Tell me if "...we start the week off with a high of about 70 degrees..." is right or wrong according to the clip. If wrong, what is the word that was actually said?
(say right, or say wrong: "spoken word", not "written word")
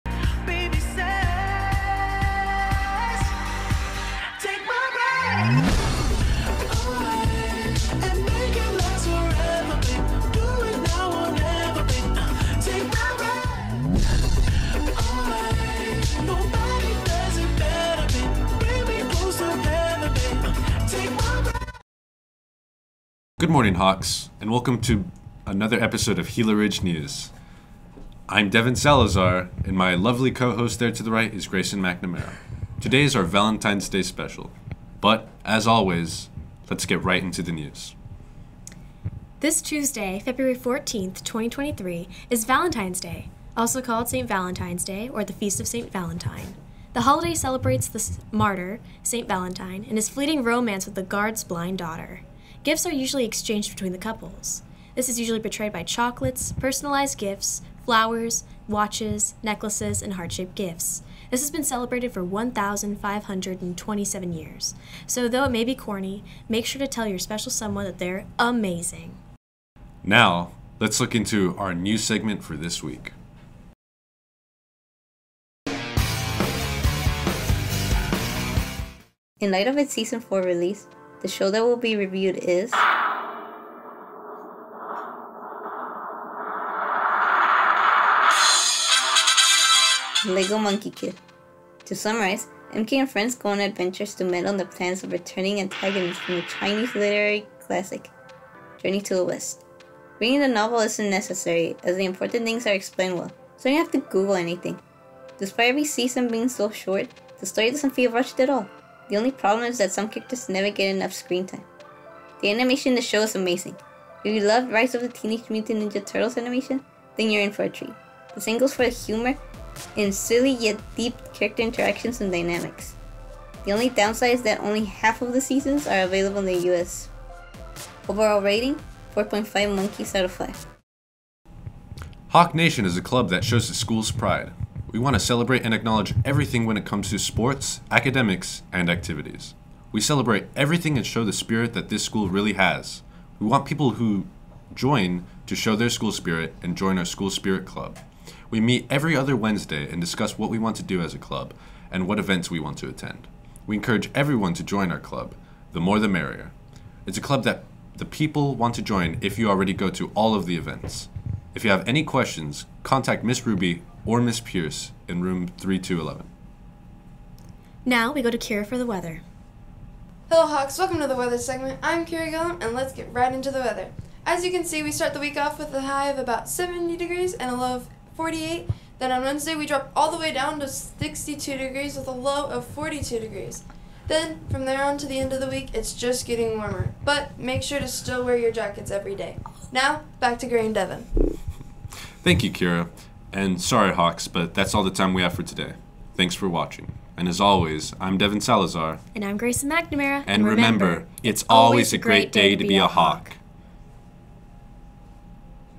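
right.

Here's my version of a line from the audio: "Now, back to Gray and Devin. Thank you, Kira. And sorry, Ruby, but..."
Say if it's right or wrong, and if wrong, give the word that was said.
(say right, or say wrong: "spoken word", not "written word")
wrong: "Hawks", not "Ruby".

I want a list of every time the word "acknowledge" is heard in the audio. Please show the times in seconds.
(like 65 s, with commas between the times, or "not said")
135 s.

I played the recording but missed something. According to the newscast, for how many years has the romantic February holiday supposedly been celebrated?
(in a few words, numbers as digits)
1,527 years.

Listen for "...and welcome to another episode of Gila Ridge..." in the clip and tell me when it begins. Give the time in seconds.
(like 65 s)
24 s.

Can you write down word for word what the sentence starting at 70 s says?
Now, let's look into our new segment for this week.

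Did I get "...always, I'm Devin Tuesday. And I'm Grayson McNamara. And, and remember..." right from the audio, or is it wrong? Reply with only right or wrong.
wrong.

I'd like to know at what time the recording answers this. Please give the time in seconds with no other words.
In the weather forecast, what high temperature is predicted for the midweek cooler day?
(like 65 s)
180 s.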